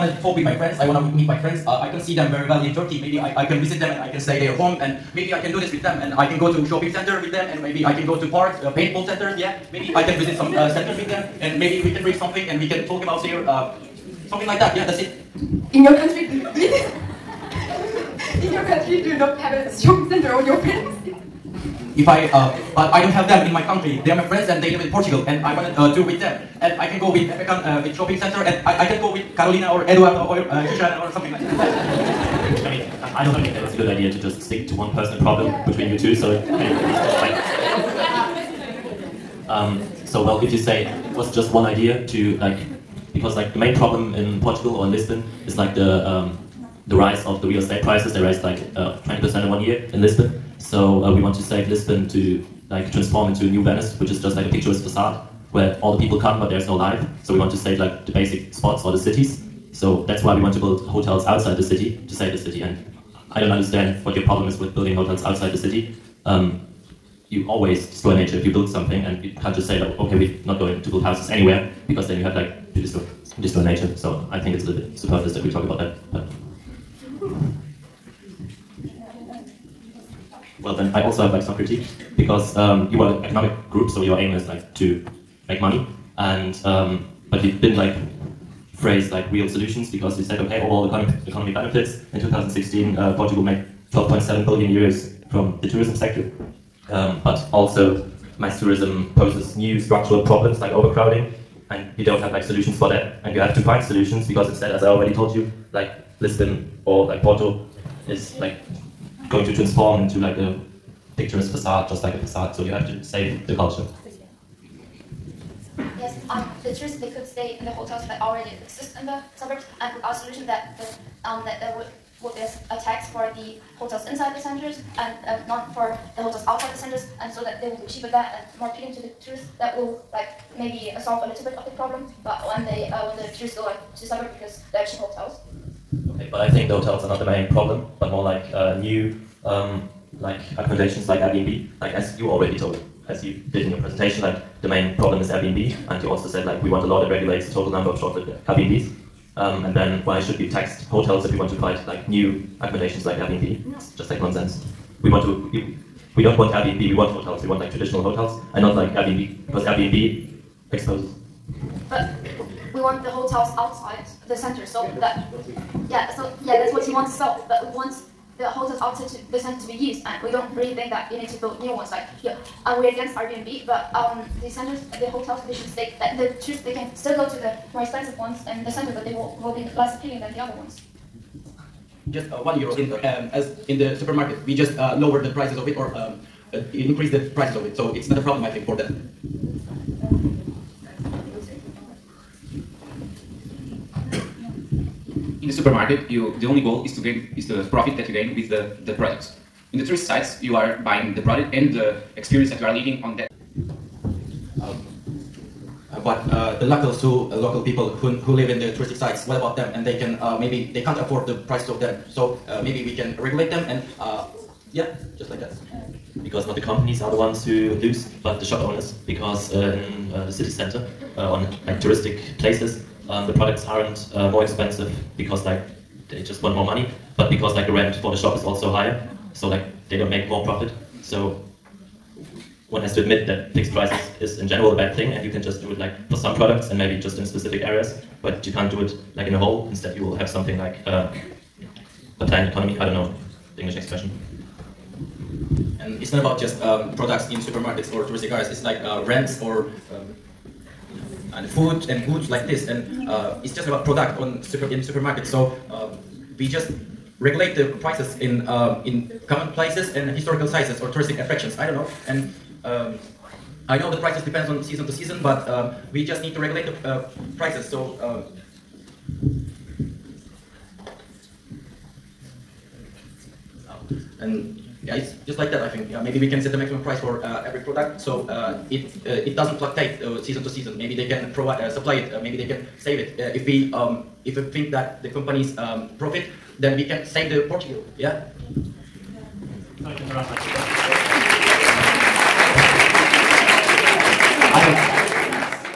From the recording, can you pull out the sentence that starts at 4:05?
And it's not about just um, products in supermarkets or touristic areas.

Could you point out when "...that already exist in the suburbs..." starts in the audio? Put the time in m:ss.
1:58.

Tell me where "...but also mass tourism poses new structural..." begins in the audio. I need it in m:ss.
1:37.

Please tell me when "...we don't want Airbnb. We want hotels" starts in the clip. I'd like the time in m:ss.
2:36.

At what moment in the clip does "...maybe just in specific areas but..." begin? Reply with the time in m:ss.
3:56.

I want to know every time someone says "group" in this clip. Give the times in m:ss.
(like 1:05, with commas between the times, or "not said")
1:23.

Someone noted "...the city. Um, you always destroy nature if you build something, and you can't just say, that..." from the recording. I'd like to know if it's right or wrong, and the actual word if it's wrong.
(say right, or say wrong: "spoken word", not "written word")
right.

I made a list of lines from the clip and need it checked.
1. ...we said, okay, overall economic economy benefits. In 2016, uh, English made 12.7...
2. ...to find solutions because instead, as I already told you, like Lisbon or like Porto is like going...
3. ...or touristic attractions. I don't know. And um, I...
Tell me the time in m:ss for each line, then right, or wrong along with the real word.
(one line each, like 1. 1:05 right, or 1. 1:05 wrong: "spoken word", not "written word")
1. 1:30 wrong: "Portugal", not "English"
2. 1:43 right
3. 4:20 right.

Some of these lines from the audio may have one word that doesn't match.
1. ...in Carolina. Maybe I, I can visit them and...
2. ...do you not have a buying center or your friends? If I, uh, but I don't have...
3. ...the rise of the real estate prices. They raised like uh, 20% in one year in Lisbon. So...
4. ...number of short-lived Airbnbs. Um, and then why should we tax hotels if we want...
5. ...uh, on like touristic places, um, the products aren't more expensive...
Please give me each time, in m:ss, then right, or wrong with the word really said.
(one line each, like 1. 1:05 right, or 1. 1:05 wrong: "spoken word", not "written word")
1. 0:02 wrong: "Turkey", not "Carolina"
2. 0:19 wrong: "shopping", not "buying"
3. 0:46 right
4. 2:27 right
5. 3:41 right.